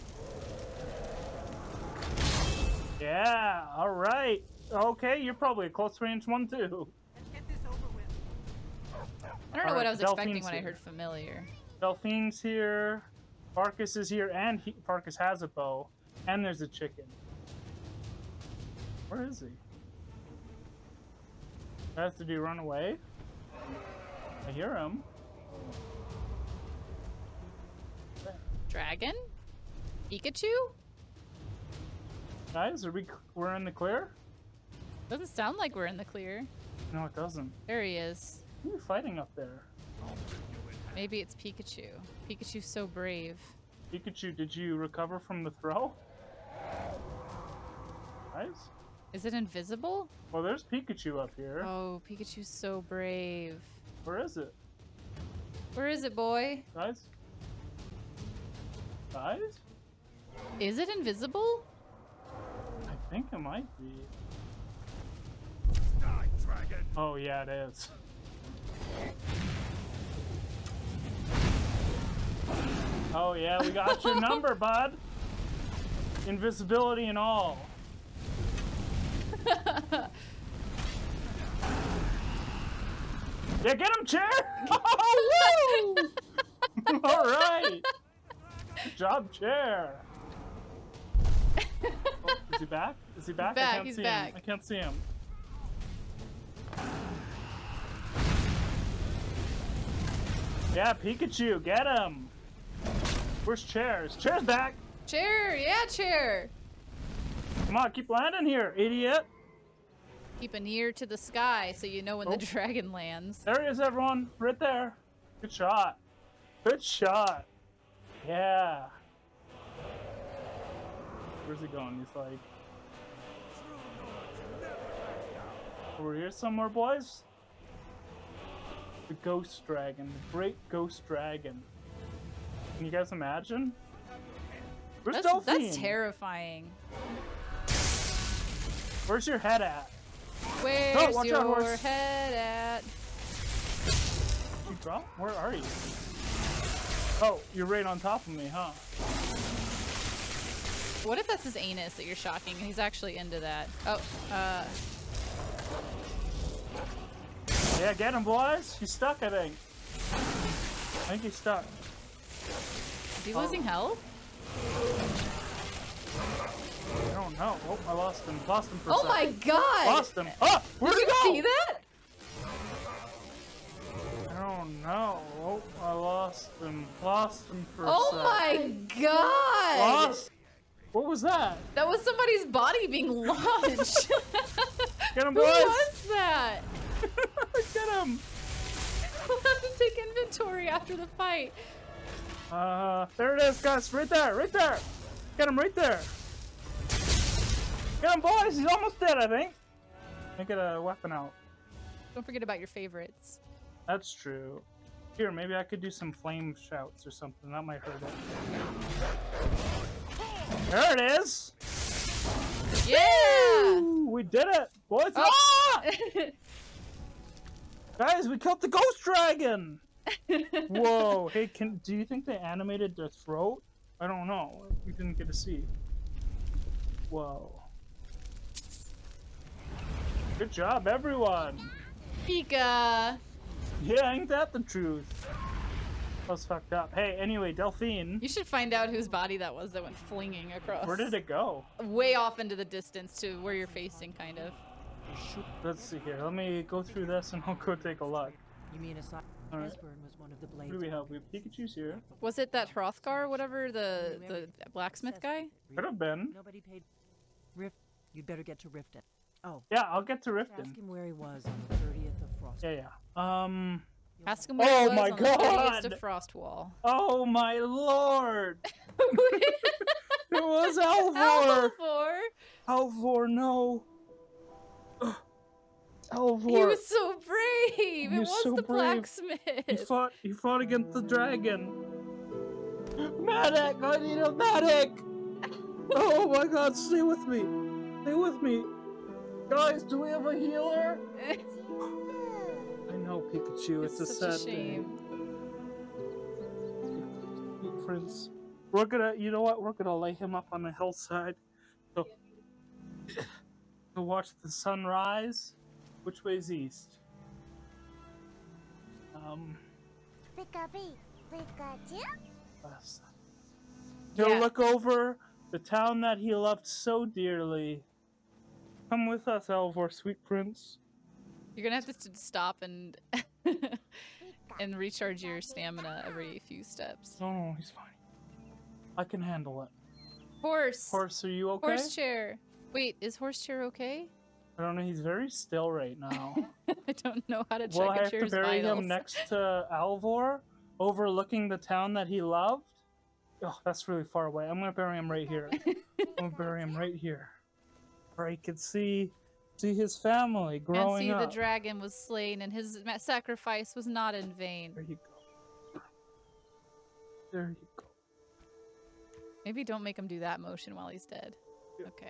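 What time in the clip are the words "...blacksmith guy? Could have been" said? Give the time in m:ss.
4:14.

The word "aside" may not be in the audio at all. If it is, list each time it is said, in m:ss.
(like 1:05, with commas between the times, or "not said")
4:08.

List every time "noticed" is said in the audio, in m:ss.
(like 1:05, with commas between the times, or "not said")
not said.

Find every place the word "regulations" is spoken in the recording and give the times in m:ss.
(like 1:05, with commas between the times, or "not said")
not said.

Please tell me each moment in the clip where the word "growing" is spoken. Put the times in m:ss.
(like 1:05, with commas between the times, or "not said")
5:50.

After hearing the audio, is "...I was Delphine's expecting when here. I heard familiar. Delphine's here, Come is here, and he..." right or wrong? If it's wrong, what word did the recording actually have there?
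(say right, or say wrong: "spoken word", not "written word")
wrong: "Farkas", not "Come".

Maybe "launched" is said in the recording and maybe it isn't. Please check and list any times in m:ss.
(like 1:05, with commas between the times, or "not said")
3:03.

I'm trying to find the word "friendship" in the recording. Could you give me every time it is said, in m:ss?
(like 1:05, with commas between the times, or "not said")
not said.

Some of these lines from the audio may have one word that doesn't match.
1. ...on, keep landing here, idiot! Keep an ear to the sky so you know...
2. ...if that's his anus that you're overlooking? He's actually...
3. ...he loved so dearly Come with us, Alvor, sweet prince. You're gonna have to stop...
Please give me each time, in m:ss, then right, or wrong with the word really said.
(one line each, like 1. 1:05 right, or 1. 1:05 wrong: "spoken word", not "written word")
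1. 1:47 right
2. 2:31 wrong: "shocking", not "overlooking"
3. 5:16 right.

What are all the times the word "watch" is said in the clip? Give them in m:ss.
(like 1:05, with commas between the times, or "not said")
5:04.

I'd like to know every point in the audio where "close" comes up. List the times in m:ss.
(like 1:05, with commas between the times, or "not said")
0:05.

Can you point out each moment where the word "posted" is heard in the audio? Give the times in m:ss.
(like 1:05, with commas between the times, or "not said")
not said.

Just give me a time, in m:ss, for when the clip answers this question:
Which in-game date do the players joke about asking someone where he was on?
4:25.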